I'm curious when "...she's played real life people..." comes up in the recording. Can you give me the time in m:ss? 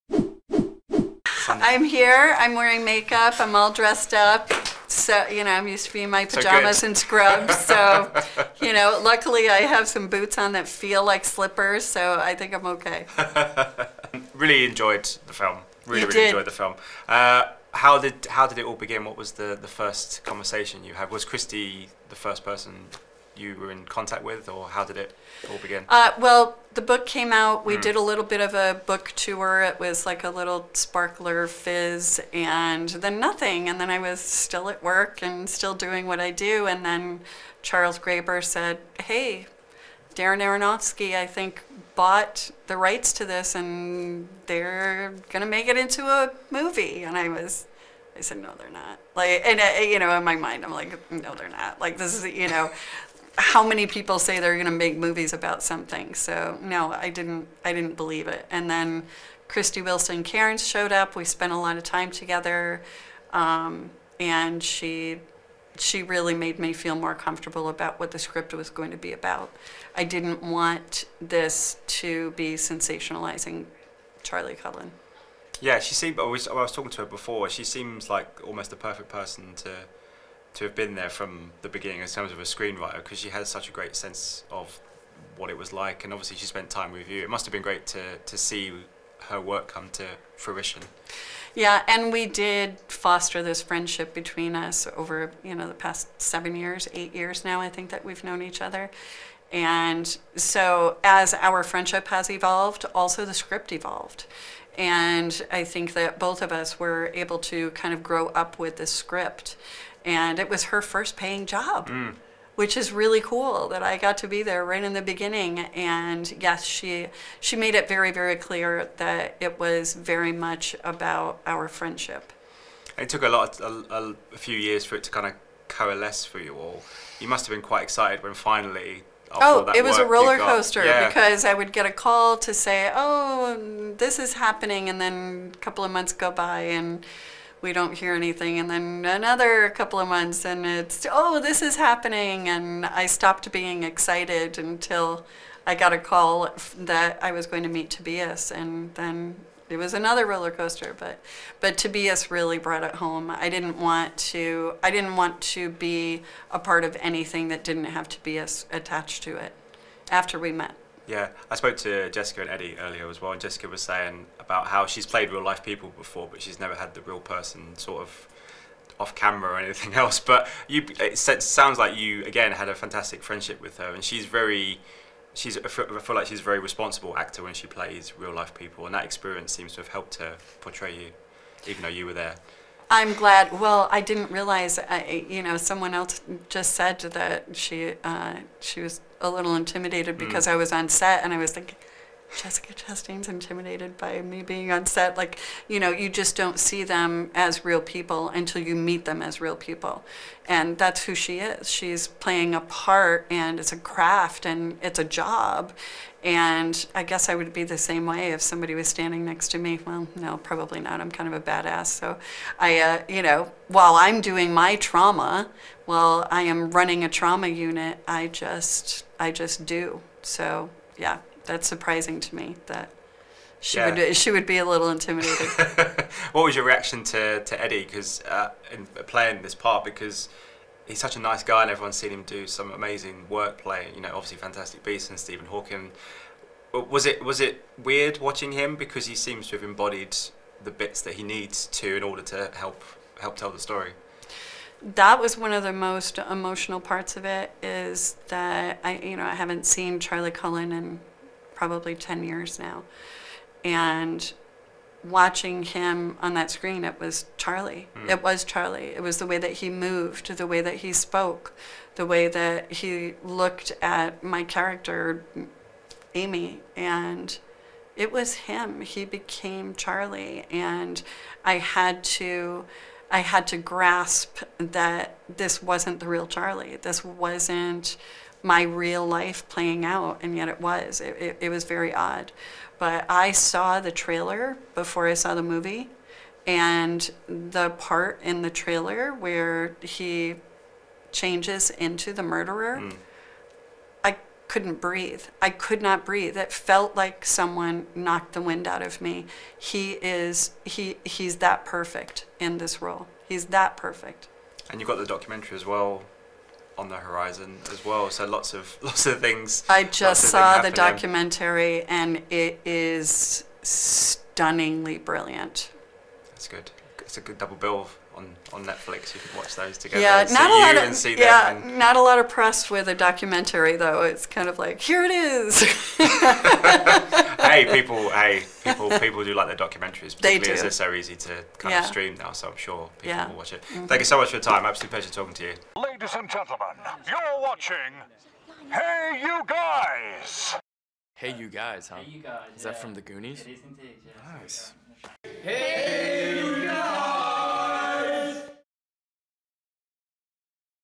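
2:44.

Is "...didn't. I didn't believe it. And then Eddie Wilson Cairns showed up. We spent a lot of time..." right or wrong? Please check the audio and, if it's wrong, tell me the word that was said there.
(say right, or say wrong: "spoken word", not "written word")
wrong: "Krysty", not "Eddie".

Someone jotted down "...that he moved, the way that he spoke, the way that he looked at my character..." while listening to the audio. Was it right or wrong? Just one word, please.
right.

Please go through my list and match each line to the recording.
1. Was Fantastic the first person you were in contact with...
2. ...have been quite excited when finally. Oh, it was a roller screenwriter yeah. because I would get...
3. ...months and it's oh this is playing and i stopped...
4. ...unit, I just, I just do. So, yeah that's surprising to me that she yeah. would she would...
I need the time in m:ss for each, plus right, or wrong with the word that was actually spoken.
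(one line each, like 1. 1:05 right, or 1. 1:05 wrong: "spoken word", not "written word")
1. 0:21 wrong: "Krysty", not "Fantastic"
2. 2:07 wrong: "coaster", not "screenwriter"
3. 2:20 wrong: "happening", not "playing"
4. 3:37 right.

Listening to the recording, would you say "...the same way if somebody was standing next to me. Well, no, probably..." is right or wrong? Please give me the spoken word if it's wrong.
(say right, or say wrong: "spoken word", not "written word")
right.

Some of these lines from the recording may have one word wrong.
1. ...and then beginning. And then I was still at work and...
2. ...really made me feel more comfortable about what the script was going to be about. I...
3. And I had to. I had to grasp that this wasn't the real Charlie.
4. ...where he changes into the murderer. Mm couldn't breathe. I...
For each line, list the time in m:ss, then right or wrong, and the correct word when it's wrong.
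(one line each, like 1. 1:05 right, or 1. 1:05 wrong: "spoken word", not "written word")
1. 0:32 wrong: "nothing", not "beginning"
2. 1:06 right
3. 4:30 right
4. 4:49 right.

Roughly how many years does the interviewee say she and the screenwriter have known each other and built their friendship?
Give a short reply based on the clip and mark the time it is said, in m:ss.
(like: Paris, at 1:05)
8 years, at 1:36.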